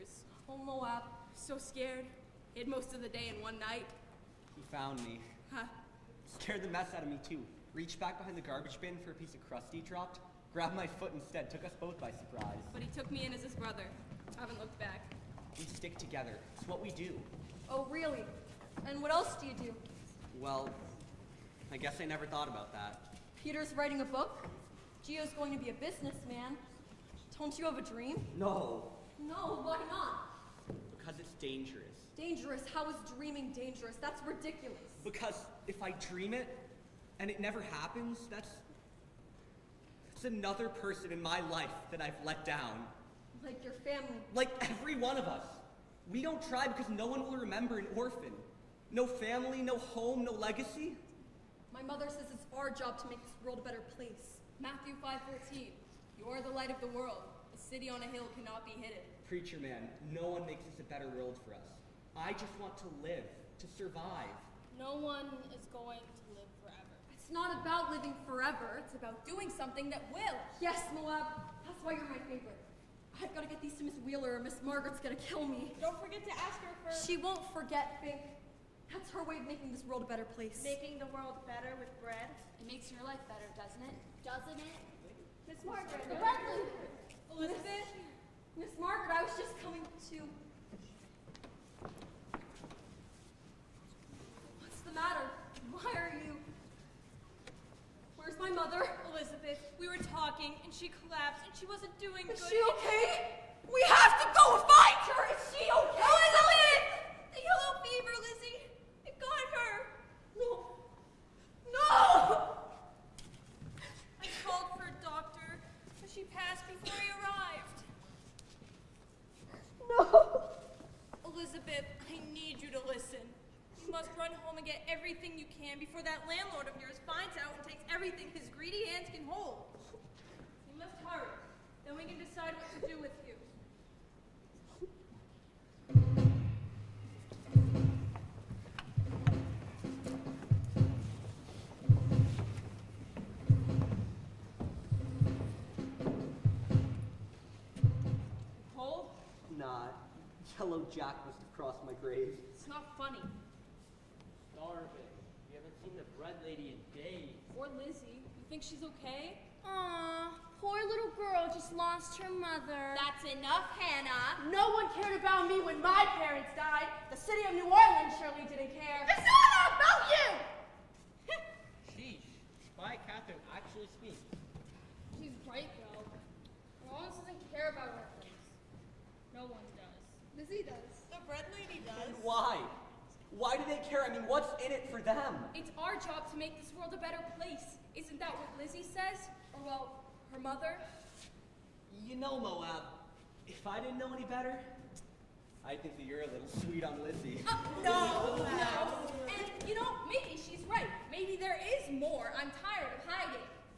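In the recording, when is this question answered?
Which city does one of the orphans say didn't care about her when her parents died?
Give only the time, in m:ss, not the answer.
2:47.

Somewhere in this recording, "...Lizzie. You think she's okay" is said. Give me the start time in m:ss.
2:37.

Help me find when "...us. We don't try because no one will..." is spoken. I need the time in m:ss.
0:45.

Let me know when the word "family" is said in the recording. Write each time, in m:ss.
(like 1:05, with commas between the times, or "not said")
0:43, 0:49.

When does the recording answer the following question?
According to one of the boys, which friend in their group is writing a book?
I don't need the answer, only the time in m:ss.
0:23.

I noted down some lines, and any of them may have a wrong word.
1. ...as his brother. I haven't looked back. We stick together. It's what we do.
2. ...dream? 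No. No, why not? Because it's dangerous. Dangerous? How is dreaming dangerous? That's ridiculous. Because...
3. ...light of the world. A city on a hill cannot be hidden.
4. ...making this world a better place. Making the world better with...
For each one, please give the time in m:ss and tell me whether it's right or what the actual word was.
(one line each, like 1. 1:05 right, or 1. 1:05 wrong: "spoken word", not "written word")
1. 0:13 right
2. 0:27 right
3. 0:56 right
4. 1:19 right.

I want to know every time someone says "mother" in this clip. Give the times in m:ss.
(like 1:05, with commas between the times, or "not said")
0:51, 1:38, 2:42, 3:10.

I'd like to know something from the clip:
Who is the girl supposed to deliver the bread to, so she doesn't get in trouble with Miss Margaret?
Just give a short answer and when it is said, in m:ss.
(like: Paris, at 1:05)
Miss Wheeler, at 1:13.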